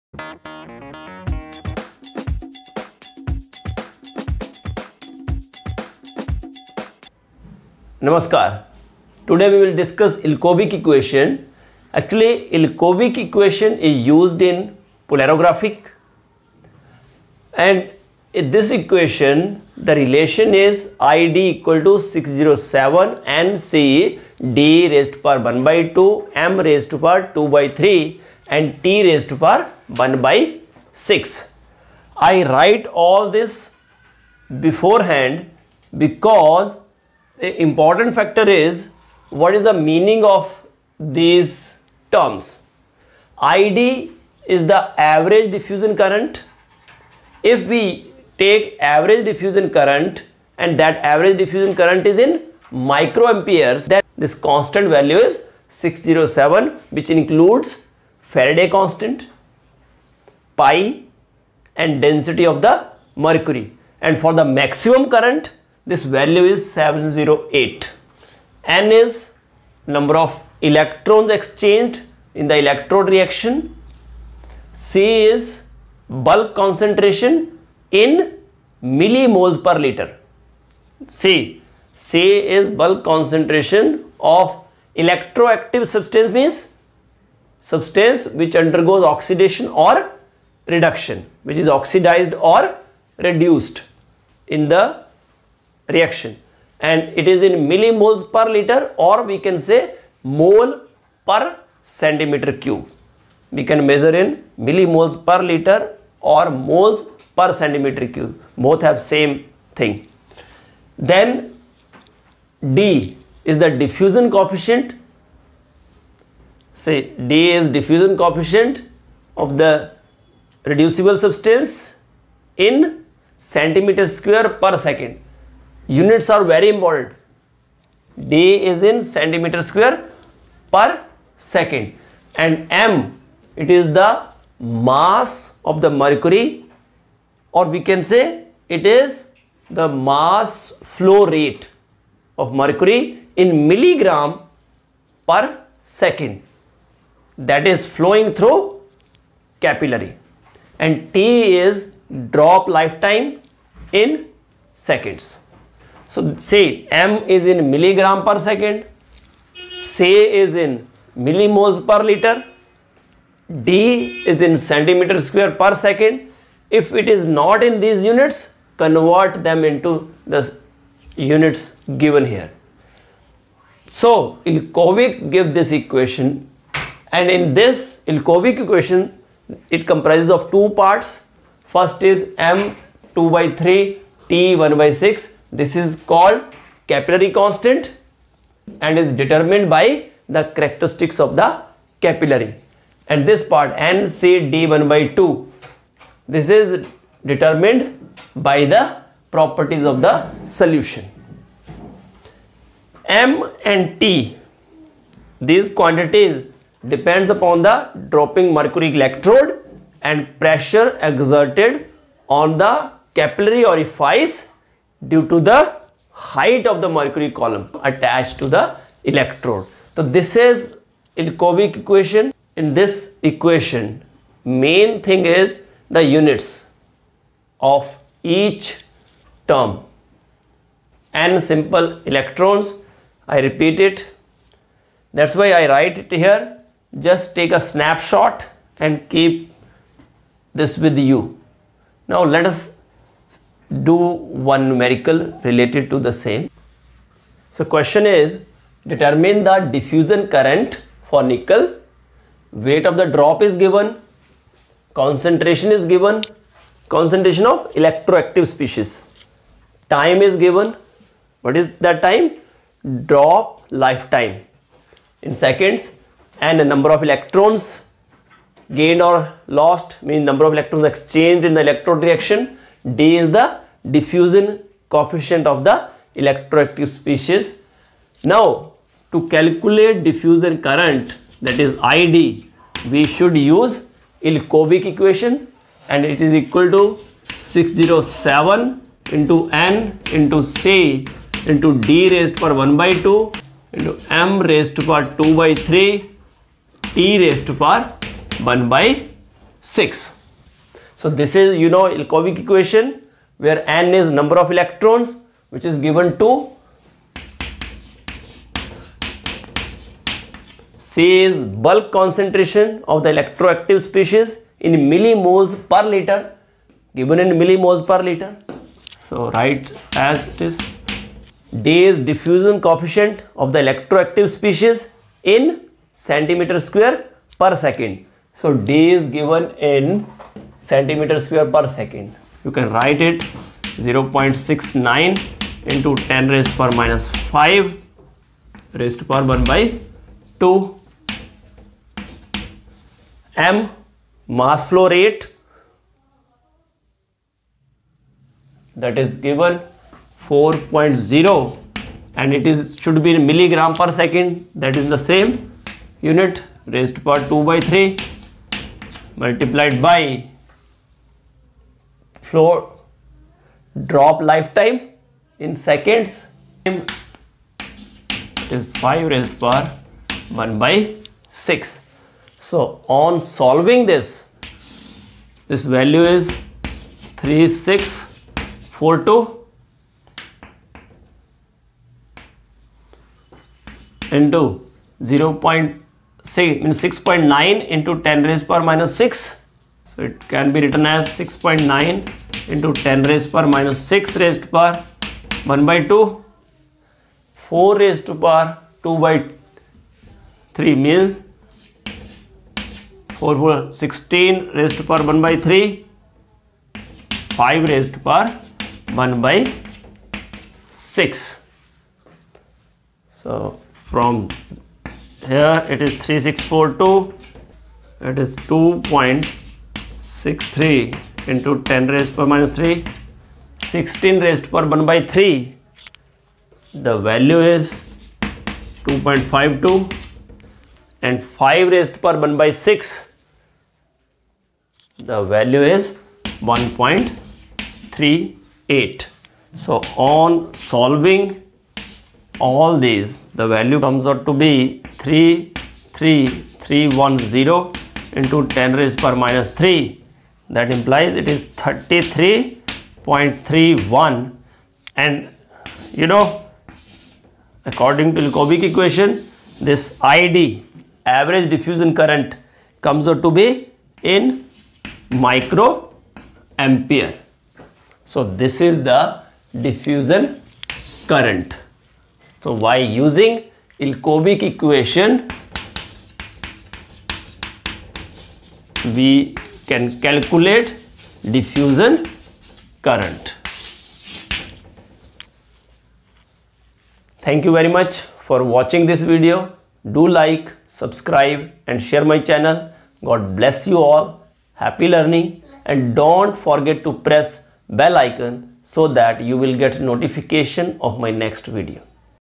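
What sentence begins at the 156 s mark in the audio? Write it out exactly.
So say M is in milligram per second, say is in millimoles per liter, D is in centimeter square per second.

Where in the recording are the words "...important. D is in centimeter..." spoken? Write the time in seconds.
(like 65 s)
126 s.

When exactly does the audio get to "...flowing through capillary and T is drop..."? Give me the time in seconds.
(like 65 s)
147 s.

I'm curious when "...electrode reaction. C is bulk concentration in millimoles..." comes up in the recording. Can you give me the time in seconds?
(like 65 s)
72 s.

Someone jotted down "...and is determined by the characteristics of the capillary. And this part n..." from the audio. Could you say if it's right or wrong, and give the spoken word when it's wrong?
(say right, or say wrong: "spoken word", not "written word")
right.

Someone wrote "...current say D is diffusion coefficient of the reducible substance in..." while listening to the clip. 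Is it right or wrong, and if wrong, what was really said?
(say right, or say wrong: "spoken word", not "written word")
wrong: "coefficient", not "current".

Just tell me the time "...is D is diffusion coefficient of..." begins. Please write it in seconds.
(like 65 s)
320 s.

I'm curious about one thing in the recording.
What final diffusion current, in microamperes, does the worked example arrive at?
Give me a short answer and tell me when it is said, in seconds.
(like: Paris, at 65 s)
33.31, at 451 s.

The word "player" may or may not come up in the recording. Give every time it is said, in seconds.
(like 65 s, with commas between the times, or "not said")
not said.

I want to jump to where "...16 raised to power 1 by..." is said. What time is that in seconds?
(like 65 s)
403 s.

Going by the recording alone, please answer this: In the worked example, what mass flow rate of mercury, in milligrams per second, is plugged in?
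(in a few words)
4.0.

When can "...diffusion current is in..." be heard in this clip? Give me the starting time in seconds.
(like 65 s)
51 s.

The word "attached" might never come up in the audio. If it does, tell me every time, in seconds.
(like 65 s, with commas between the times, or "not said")
217 s.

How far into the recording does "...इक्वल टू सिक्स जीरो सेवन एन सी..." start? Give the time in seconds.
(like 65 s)
21 s.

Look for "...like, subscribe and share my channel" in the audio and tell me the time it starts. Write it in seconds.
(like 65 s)
490 s.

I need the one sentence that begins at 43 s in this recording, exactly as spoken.
ID is the average diffusion current.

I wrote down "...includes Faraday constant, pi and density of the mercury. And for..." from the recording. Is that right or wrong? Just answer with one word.
right.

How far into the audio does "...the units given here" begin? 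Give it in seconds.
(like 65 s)
170 s.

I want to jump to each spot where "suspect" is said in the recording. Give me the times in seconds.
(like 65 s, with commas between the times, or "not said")
not said.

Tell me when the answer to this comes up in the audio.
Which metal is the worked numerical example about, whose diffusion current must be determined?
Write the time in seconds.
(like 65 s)
251 s.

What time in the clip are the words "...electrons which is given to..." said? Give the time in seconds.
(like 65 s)
304 s.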